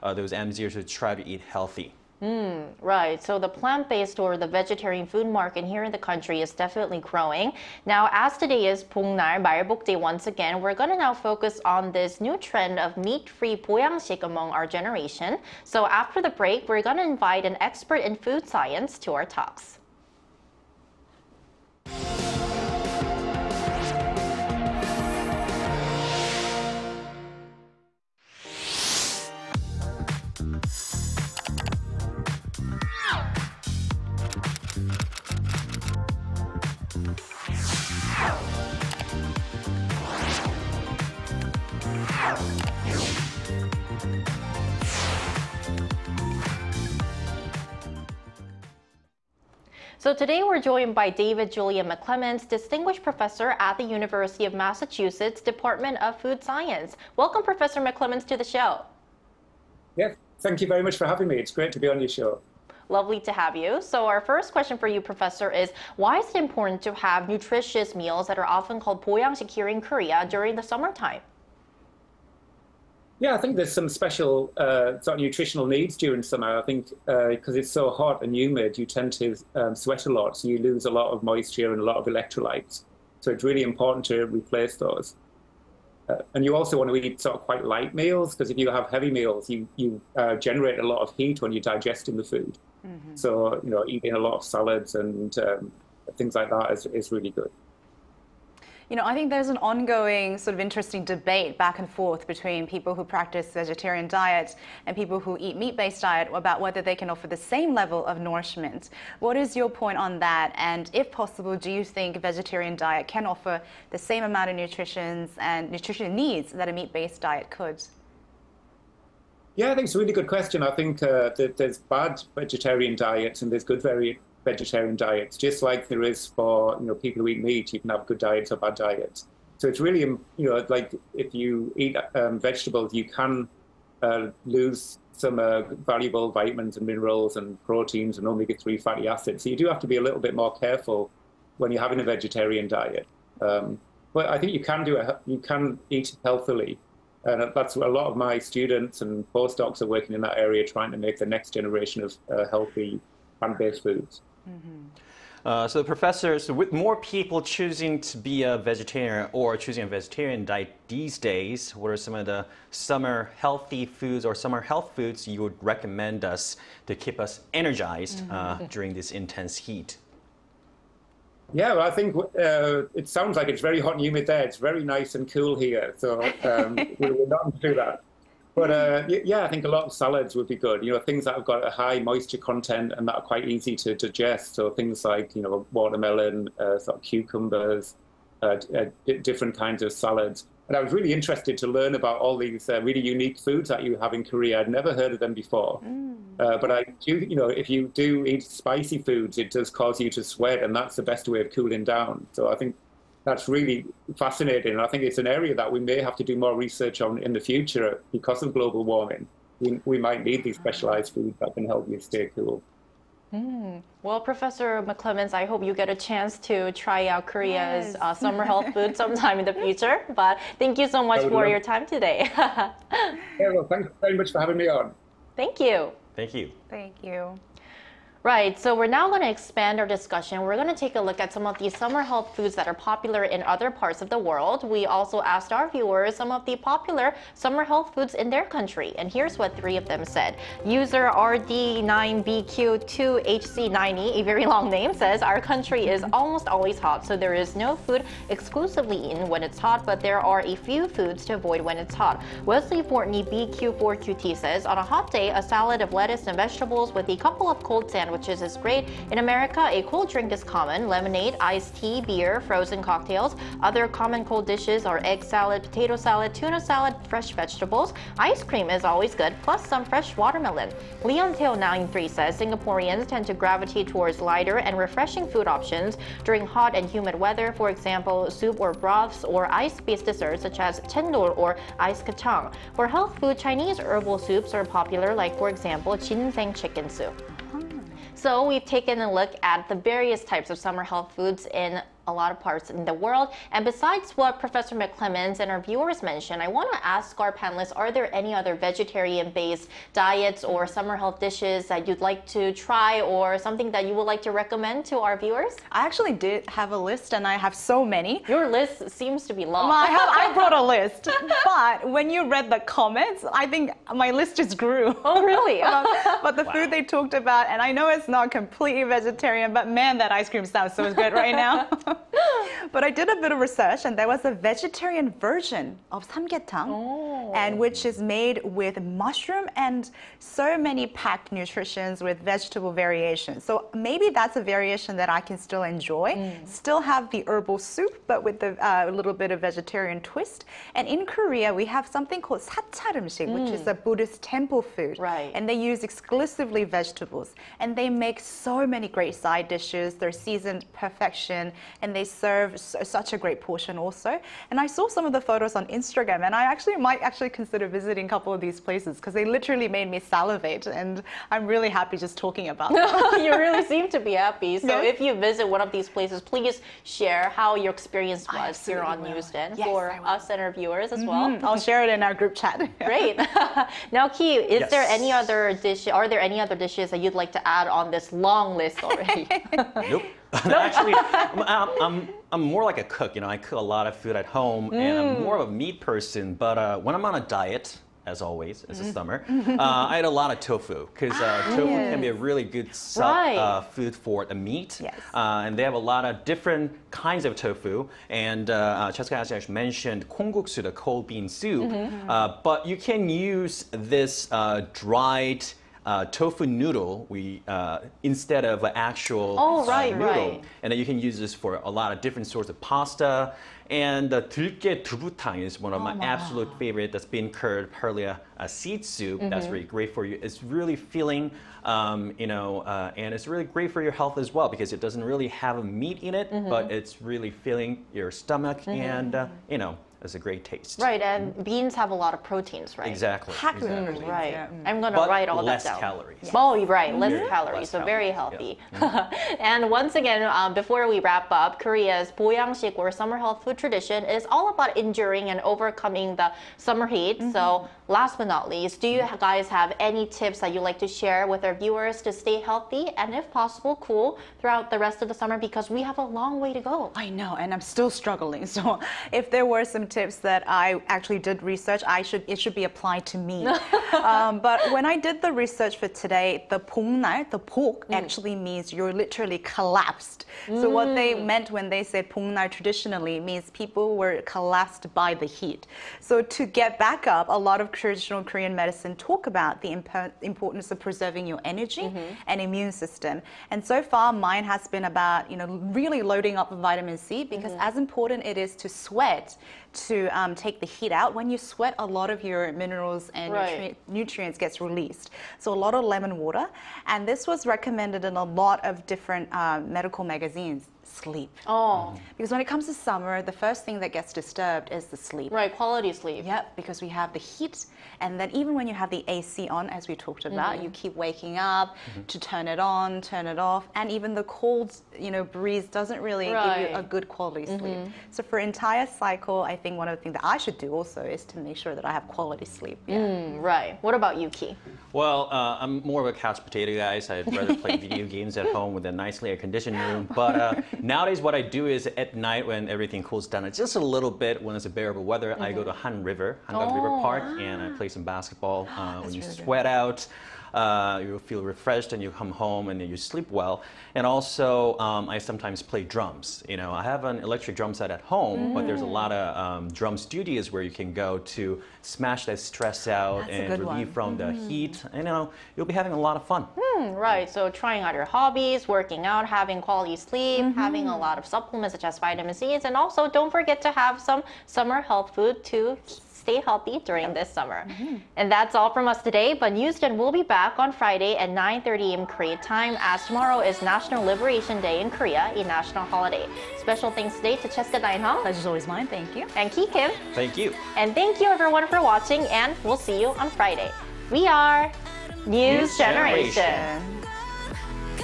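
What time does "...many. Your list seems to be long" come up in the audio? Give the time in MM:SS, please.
05:07.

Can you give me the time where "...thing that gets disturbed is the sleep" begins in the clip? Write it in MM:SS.
08:23.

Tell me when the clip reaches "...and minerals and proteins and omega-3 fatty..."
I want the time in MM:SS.
02:16.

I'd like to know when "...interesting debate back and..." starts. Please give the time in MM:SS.
01:40.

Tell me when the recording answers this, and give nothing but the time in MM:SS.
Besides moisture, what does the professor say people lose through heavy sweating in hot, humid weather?
01:22.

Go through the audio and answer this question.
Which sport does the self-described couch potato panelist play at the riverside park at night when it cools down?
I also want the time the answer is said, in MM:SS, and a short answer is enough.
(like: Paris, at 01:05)
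basketball, at 08:58.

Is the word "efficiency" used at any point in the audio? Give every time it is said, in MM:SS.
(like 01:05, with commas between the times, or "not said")
not said.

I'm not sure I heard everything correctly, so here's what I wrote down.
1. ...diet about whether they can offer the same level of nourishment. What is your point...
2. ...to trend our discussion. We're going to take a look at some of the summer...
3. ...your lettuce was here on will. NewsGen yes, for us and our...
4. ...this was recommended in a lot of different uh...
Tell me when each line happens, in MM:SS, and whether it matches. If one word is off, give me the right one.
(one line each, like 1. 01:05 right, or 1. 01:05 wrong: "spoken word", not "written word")
1. 01:46 right
2. 03:49 wrong: "expand", not "trend"
3. 06:07 wrong: "experience", not "lettuce"
4. 08:17 right.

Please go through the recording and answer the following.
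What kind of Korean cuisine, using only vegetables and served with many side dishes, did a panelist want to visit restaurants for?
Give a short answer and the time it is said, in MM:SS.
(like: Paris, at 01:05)
Buddhist temple food, at 05:43.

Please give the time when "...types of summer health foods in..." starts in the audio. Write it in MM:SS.
04:50.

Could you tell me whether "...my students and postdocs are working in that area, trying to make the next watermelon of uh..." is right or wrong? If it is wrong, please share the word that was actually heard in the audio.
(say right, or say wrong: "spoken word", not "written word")
wrong: "generation", not "watermelon".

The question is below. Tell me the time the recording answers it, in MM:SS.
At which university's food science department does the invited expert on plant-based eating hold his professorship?
00:53.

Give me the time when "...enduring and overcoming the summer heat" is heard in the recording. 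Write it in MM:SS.
07:24.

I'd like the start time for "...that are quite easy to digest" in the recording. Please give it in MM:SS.
03:03.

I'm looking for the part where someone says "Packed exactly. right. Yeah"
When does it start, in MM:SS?
07:13.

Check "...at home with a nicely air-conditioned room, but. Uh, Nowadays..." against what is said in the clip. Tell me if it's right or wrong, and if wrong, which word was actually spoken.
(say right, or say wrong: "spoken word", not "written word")
right.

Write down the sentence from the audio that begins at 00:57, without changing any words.
Welcome, Professor McClements, to the show.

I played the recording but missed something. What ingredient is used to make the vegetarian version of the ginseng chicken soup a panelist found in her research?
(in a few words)
mushroom.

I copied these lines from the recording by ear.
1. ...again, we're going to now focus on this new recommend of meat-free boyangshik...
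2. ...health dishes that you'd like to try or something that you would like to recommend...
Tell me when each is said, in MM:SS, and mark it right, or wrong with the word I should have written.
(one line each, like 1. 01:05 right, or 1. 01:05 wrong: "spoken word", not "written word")
1. 00:10 wrong: "trend", not "recommend"
2. 05:00 right.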